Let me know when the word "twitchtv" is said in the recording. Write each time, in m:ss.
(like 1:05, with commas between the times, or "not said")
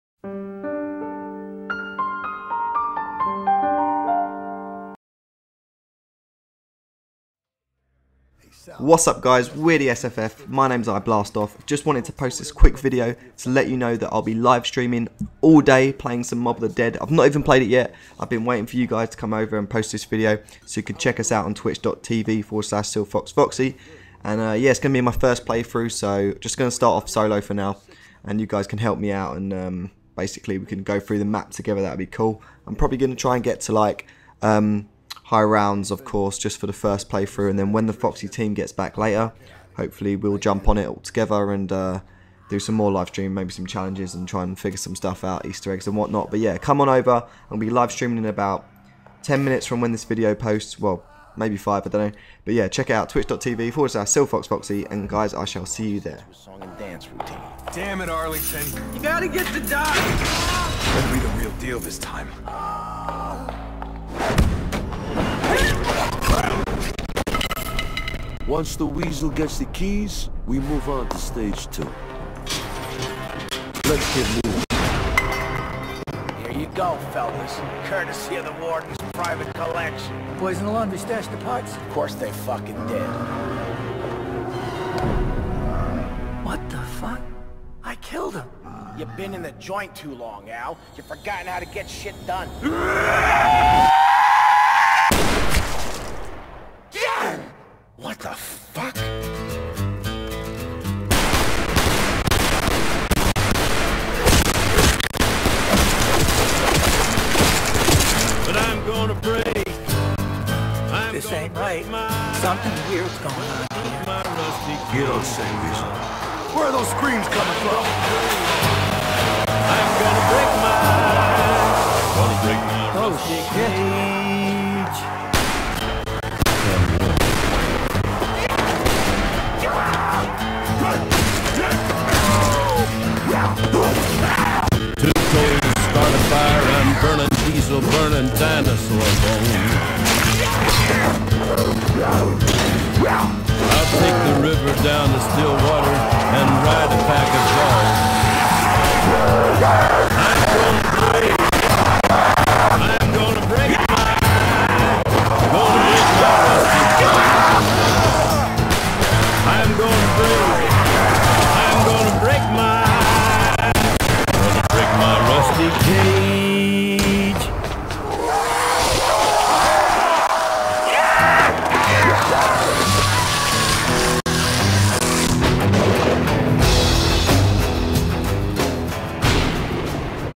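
0:21, 0:53.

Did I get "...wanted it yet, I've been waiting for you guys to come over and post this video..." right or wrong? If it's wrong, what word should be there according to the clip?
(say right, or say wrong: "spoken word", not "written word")
wrong: "played", not "wanted".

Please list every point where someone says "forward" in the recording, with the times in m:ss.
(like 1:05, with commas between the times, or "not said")
0:22, 0:53.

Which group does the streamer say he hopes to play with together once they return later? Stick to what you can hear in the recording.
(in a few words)
the Foxy team.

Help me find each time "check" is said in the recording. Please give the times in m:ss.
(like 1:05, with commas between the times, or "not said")
0:20, 0:52.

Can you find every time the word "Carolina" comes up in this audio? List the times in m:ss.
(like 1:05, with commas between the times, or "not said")
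not said.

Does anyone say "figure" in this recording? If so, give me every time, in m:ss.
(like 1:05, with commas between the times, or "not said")
0:44.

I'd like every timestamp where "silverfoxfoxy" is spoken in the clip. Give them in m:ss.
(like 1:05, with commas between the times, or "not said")
0:22, 0:54.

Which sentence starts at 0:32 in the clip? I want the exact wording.
I'm probably going to try and get to like...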